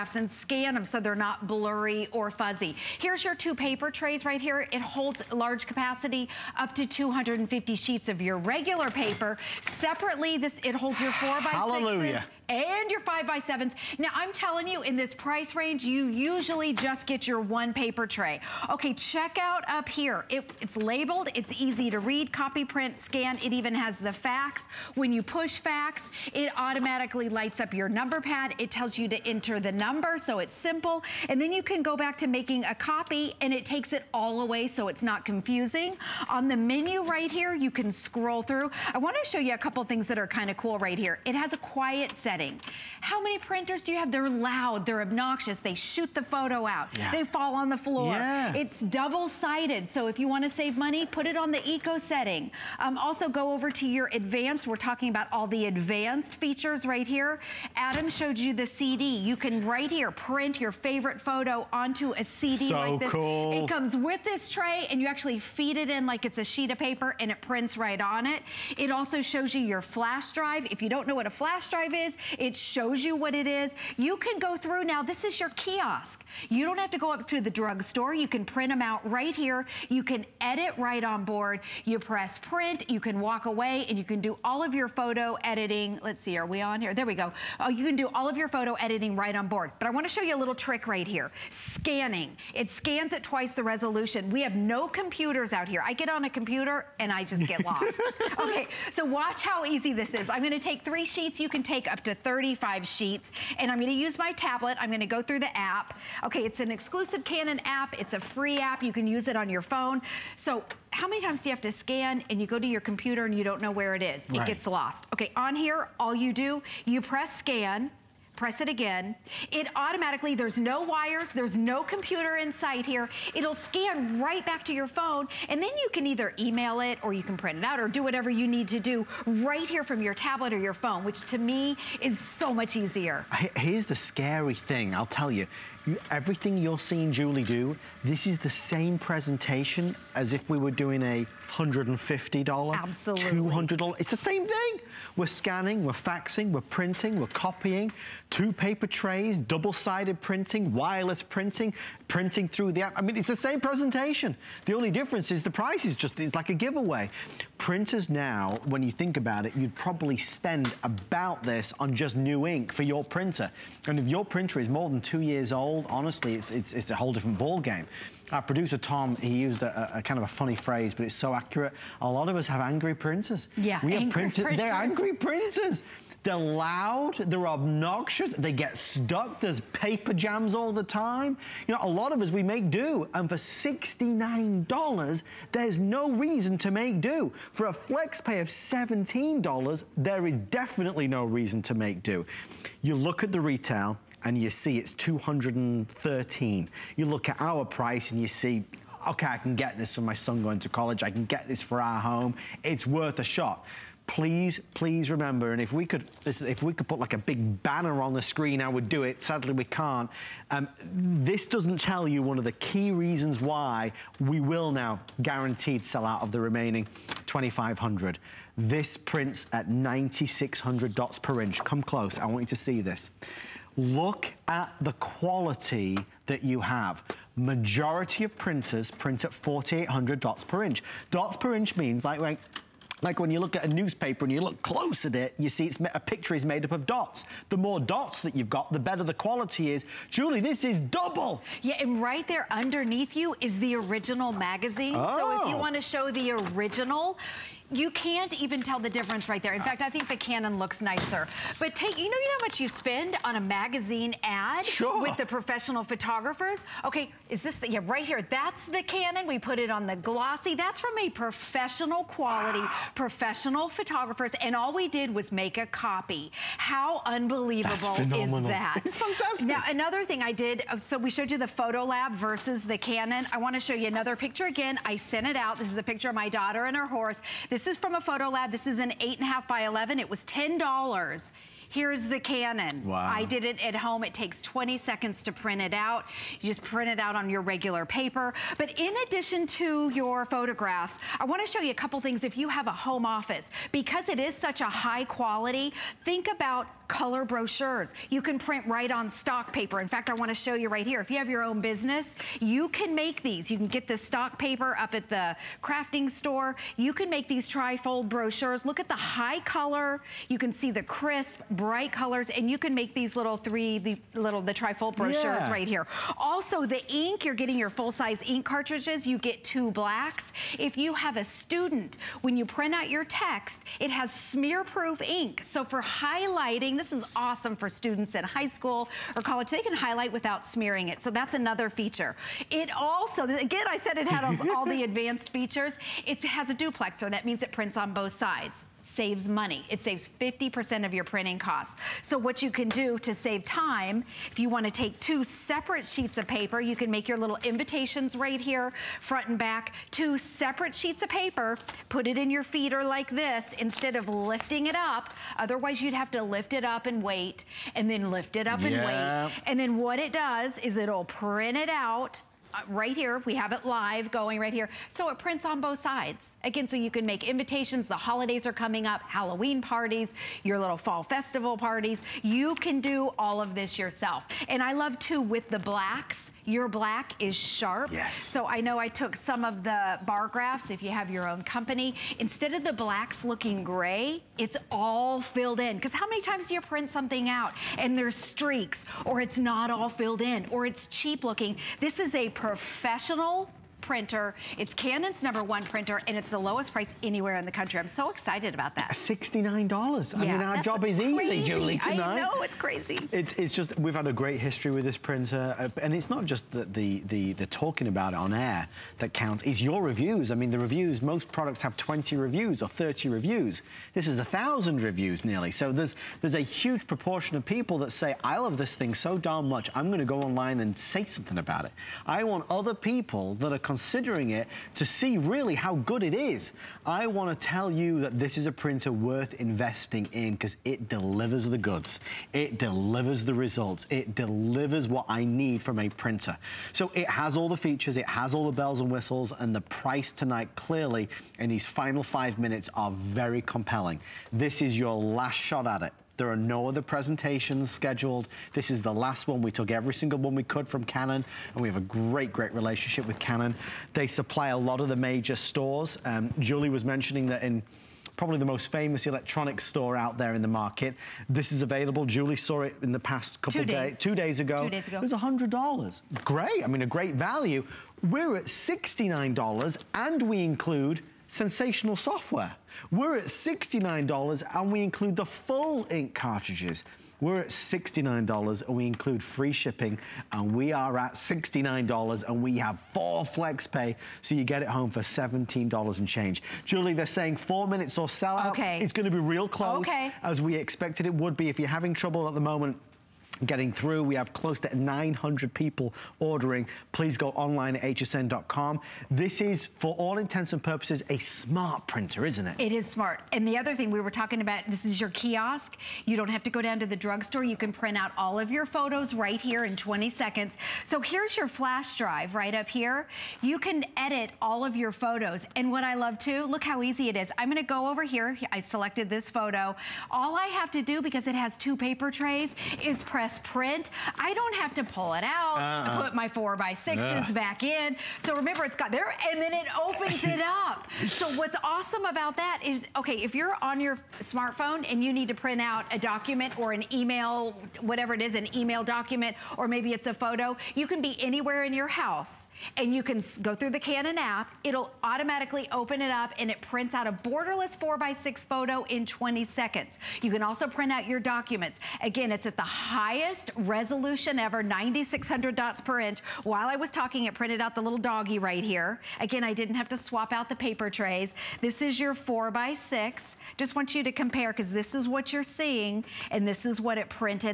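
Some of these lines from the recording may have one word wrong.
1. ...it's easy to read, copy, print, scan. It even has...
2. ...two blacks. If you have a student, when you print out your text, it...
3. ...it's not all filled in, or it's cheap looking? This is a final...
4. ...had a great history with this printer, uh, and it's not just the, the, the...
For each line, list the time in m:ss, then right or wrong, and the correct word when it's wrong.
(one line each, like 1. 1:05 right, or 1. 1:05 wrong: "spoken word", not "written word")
1. 0:21 right
2. 5:19 right
3. 6:29 wrong: "professional", not "final"
4. 6:43 right.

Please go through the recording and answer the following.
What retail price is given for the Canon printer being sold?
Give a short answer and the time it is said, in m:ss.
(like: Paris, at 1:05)
$213, at 3:14.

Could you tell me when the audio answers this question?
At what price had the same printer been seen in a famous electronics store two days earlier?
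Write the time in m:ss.
7:45.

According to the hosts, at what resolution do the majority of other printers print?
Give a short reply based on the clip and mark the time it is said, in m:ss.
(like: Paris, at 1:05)
4,800 dots per inch, at 3:49.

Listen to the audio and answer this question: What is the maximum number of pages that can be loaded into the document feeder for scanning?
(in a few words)
35.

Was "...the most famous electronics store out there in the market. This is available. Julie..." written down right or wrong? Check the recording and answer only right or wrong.
right.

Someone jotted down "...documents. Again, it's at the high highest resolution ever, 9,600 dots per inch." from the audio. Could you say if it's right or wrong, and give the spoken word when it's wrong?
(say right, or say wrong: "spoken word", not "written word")
right.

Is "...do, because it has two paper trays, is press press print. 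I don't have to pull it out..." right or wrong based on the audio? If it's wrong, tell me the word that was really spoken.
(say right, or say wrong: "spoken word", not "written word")
right.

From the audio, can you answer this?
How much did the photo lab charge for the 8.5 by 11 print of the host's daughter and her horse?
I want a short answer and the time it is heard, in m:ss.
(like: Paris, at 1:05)
$10, at 4:40.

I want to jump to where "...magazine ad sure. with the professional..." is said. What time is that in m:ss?
4:13.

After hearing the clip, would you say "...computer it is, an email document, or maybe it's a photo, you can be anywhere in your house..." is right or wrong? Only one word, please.
wrong.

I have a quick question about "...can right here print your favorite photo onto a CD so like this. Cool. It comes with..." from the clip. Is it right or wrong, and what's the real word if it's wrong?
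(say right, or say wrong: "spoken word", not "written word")
right.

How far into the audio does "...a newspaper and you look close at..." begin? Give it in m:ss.
3:53.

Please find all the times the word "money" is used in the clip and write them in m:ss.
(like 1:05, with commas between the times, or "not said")
0:50, 5:39.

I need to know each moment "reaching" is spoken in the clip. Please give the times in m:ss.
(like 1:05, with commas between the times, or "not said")
not said.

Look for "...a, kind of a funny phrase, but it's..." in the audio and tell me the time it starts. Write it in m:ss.
2:49.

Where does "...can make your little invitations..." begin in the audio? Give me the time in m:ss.
5:46.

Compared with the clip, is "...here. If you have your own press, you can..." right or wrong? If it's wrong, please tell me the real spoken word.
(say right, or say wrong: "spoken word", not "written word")
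wrong: "business", not "press".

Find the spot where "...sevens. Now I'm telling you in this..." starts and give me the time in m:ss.
0:13.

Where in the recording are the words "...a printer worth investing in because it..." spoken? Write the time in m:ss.
7:08.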